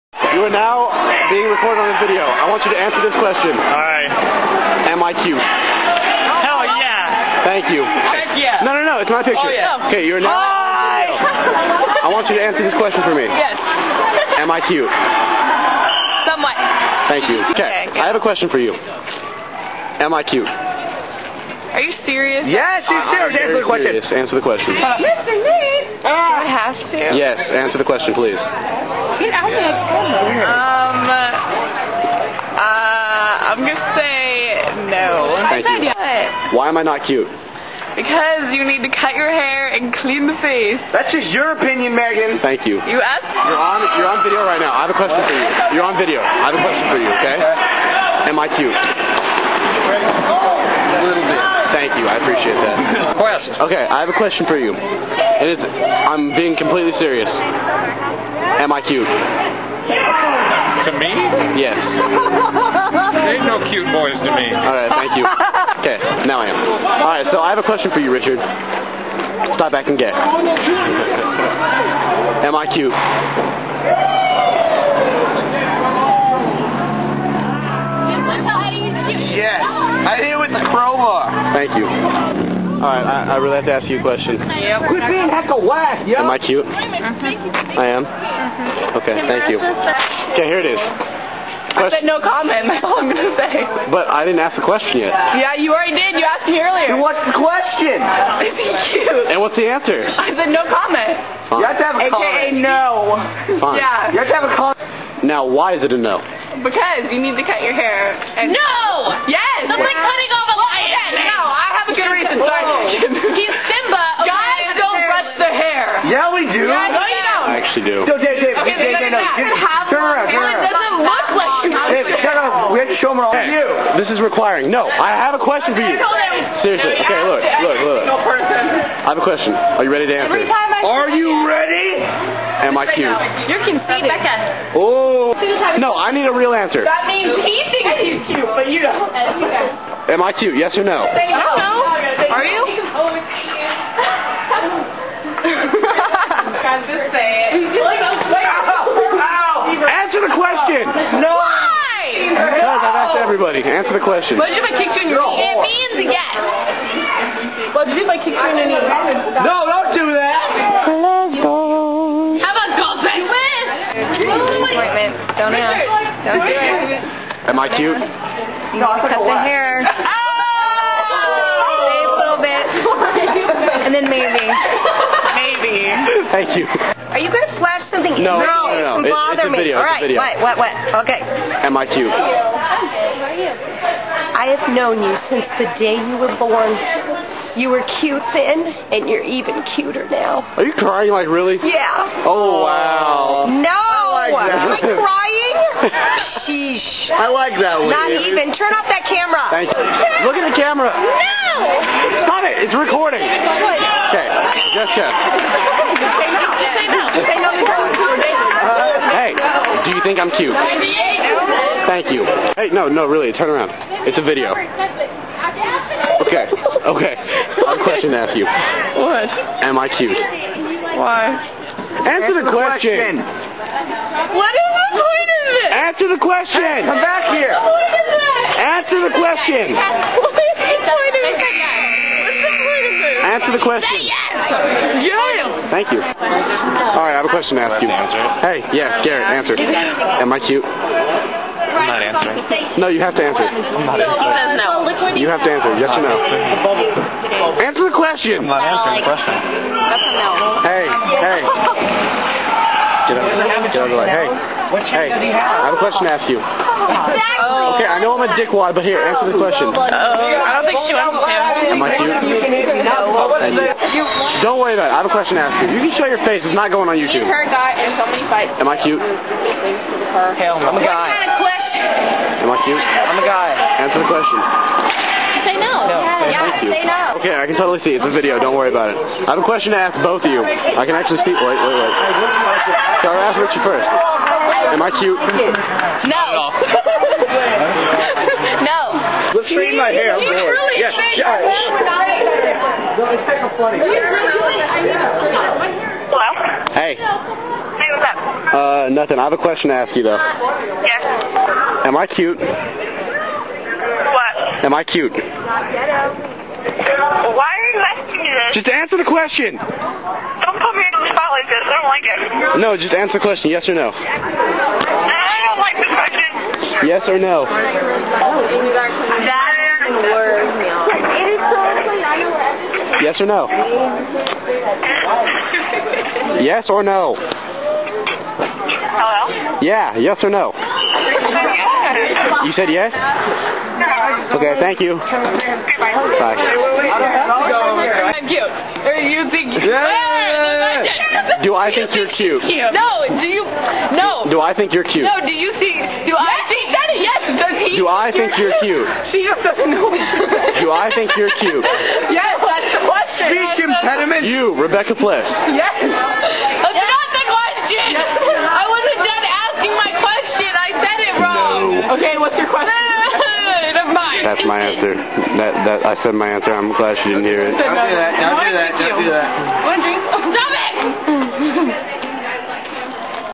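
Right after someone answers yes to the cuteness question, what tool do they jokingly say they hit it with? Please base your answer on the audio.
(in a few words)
crowbar.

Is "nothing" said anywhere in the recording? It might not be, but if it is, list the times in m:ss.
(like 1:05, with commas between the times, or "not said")
4:58.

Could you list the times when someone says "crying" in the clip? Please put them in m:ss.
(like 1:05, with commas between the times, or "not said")
3:10, 3:14.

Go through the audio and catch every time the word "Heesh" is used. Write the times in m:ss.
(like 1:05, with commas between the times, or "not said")
3:16.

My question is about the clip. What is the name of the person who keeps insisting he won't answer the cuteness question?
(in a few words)
Garrett.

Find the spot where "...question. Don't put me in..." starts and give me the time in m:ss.
5:09.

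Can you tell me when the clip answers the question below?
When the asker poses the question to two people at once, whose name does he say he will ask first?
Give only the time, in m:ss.
4:43.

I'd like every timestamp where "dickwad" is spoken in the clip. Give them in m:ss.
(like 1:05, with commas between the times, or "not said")
4:18.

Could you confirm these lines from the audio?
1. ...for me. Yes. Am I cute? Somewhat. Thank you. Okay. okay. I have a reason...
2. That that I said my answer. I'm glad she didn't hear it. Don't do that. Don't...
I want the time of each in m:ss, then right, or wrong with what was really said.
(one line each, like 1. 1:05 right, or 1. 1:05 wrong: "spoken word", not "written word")
1. 0:13 wrong: "question", not "reason"
2. 6:05 right.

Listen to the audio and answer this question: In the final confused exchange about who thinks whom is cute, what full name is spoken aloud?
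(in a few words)
Rebecca Bliss.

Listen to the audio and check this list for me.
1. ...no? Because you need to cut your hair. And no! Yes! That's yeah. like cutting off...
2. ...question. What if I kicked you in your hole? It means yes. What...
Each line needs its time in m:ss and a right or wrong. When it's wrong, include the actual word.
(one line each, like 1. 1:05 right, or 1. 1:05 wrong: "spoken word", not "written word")
1. 1:45 right
2. 2:34 right.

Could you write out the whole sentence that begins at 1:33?
But I didn't ask the question yet.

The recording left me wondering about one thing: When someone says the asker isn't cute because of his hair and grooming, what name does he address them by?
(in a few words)
Megan.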